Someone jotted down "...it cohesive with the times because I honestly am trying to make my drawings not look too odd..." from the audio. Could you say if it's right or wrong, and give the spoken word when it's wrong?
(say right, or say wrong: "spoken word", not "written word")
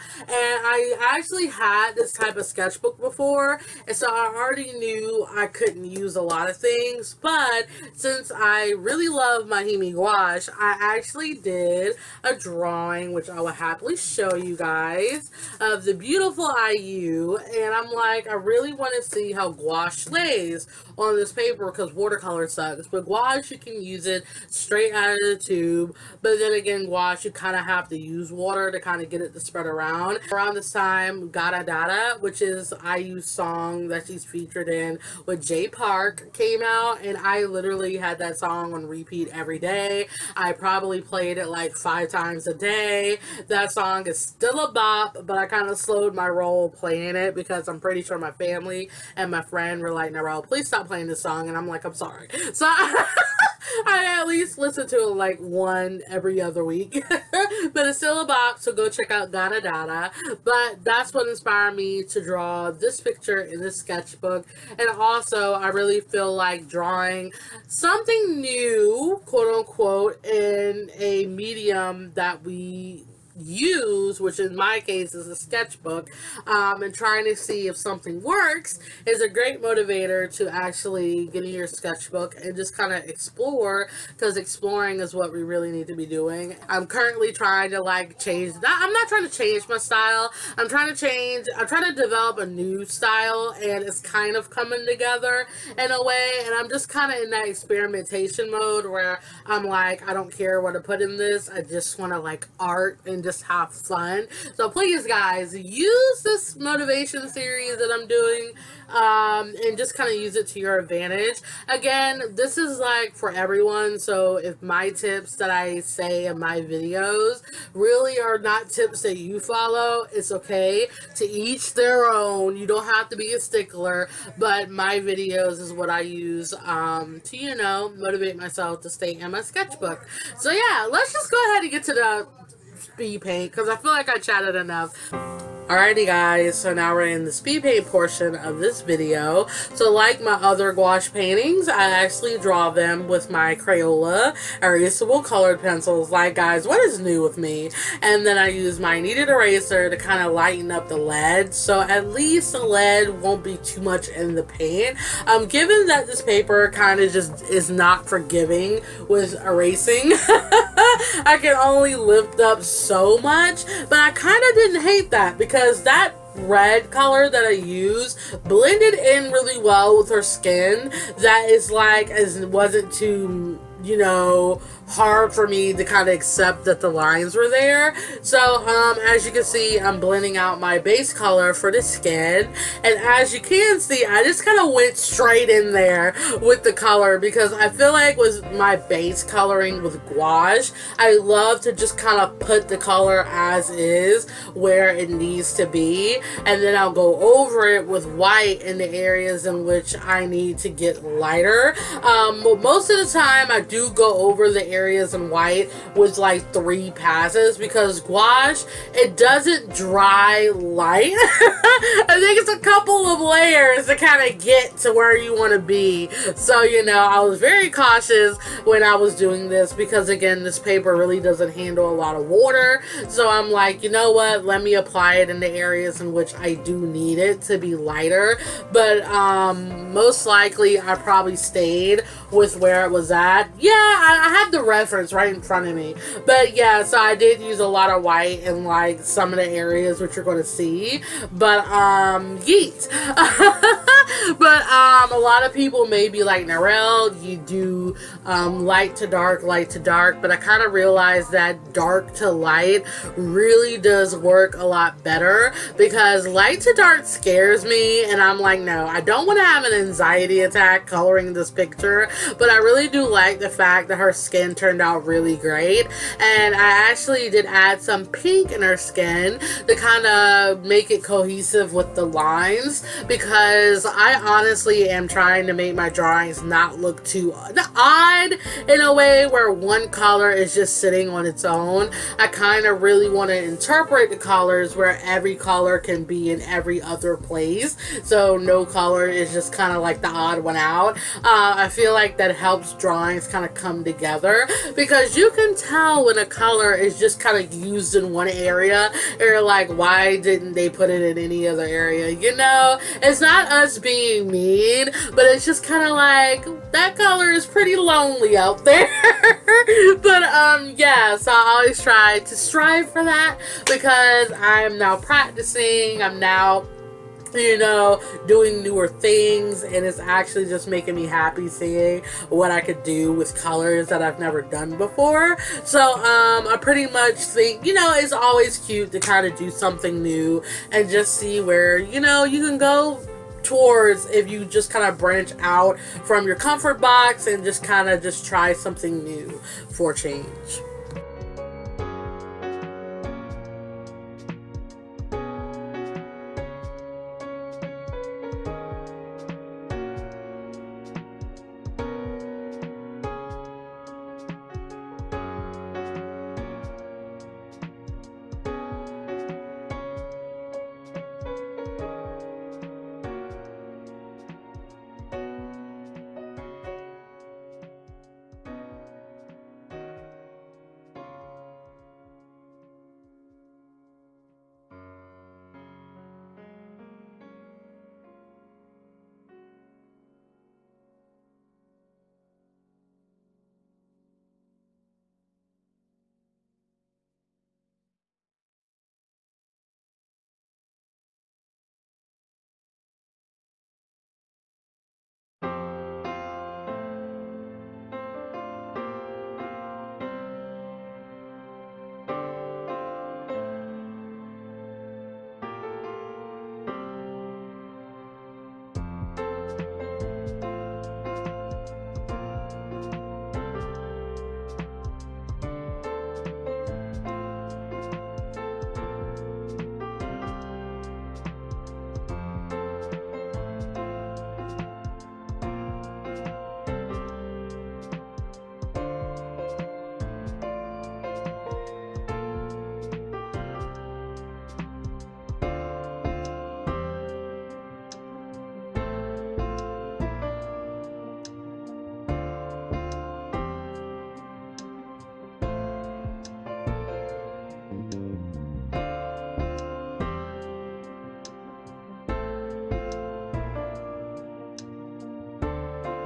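wrong: "lines", not "times".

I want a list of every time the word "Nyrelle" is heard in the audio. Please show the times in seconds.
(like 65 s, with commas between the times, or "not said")
50 s, 246 s.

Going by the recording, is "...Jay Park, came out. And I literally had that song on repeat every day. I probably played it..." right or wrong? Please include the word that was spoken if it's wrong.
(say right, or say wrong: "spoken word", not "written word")
right.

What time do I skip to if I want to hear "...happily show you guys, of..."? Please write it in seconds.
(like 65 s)
13 s.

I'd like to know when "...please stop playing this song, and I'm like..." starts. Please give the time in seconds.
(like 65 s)
50 s.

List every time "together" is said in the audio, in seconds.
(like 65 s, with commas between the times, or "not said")
94 s, 293 s.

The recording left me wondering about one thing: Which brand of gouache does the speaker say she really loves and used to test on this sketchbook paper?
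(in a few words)
Mahimi.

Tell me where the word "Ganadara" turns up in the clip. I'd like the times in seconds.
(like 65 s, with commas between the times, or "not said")
31 s, 59 s.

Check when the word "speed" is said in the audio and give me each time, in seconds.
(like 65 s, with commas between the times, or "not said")
132 s, 137 s.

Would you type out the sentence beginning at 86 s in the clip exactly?
I'm currently trying to like change, that.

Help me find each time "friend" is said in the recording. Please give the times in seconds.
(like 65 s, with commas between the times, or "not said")
49 s.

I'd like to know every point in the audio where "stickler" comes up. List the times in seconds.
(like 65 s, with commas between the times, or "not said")
123 s.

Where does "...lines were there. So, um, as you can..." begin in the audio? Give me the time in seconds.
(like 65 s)
176 s.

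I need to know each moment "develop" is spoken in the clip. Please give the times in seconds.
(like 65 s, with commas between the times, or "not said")
92 s.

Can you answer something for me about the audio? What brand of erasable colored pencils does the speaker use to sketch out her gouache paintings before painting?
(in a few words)
Crayola.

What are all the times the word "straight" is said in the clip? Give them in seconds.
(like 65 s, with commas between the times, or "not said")
24 s, 184 s.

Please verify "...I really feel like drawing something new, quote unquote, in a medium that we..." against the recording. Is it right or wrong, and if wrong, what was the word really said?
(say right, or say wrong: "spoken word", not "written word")
right.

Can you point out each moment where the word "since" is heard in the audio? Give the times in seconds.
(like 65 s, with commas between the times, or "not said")
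7 s.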